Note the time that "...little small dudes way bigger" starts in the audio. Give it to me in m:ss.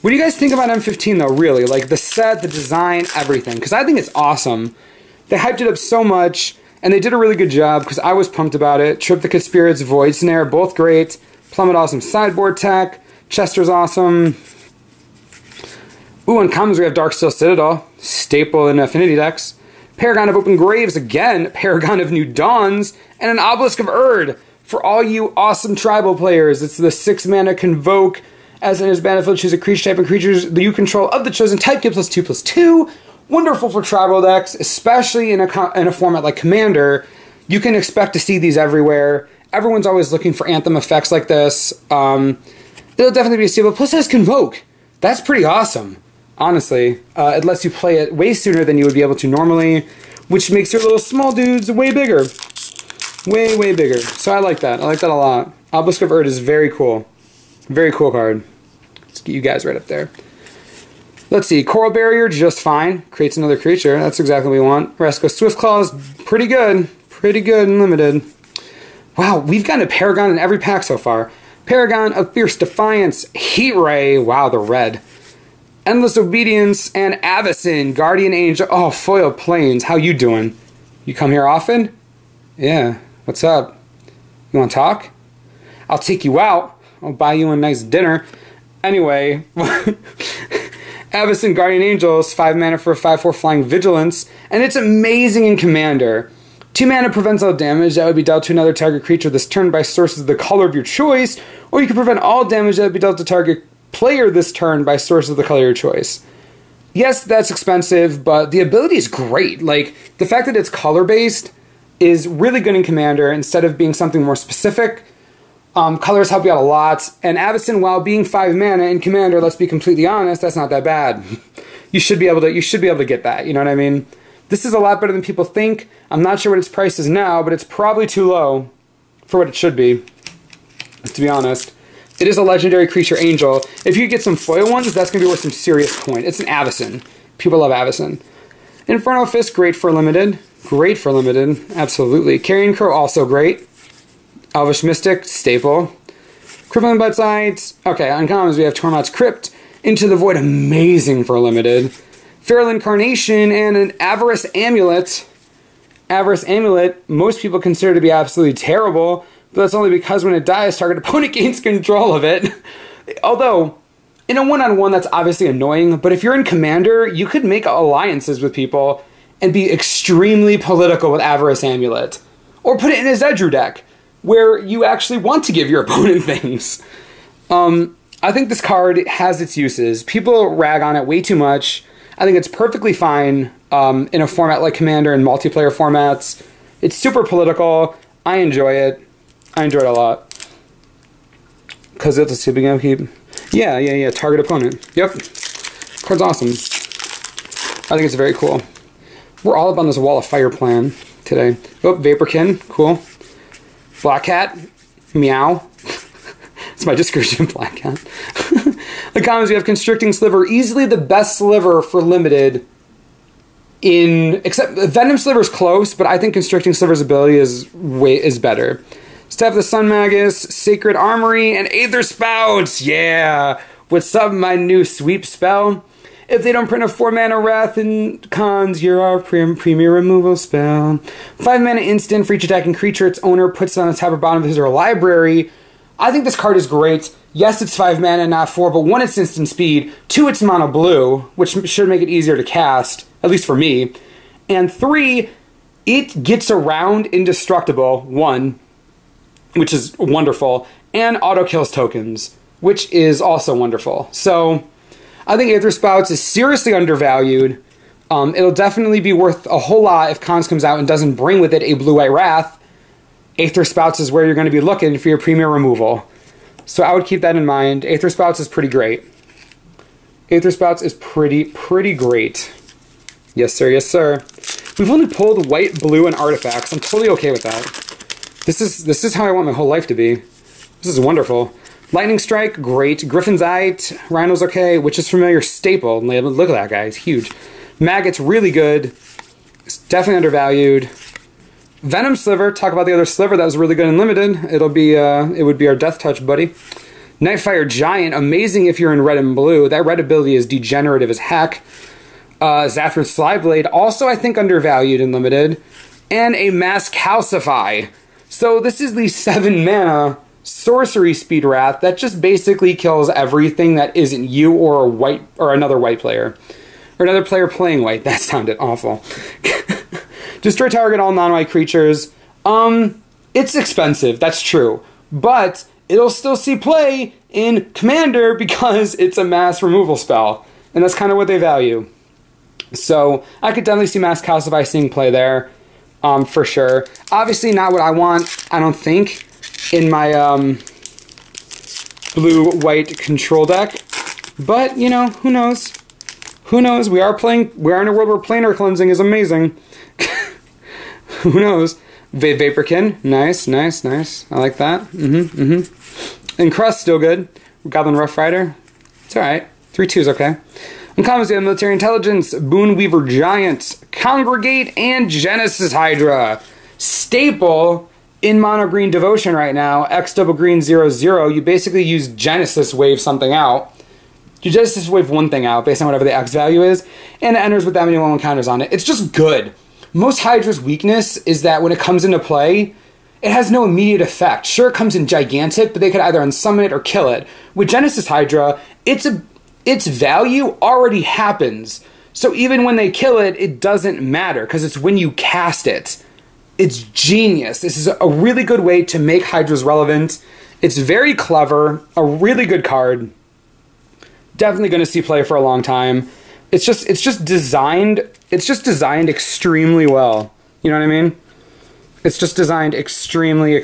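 0:50.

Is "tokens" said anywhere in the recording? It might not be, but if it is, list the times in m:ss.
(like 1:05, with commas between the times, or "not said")
4:11.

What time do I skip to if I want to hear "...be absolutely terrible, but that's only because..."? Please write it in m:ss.
2:38.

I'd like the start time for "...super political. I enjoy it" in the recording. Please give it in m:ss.
3:06.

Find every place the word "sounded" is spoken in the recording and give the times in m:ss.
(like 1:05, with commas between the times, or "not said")
5:18.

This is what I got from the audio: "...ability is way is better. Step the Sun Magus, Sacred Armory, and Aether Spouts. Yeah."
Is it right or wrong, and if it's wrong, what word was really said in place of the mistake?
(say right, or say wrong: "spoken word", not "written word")
right.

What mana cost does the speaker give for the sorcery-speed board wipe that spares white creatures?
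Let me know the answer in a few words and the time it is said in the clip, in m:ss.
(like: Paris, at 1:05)
7, at 5:09.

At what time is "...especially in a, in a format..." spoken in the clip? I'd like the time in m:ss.
0:34.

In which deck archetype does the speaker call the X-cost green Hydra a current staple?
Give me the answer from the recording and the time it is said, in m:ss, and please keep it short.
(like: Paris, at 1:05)
Mono green devotion, at 6:08.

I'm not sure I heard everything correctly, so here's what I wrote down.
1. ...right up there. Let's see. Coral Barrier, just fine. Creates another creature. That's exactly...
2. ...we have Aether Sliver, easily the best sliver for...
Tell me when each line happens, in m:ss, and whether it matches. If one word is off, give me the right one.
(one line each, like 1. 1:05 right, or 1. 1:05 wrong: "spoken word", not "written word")
1. 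0:59 right
2. 3:29 wrong: "Constricting", not "Aether".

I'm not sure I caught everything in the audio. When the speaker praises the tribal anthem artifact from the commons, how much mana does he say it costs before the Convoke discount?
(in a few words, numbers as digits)
6.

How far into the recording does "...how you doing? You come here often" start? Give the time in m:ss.
1:19.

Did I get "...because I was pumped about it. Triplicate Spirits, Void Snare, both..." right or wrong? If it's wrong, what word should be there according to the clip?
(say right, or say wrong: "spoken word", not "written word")
right.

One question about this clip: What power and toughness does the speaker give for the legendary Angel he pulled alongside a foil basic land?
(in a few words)
5/4.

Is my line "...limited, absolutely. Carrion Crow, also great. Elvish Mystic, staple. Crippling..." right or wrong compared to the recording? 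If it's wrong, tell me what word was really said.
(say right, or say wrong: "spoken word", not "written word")
right.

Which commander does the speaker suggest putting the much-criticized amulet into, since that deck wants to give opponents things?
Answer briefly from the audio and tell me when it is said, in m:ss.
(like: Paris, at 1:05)
Zedruu, at 2:53.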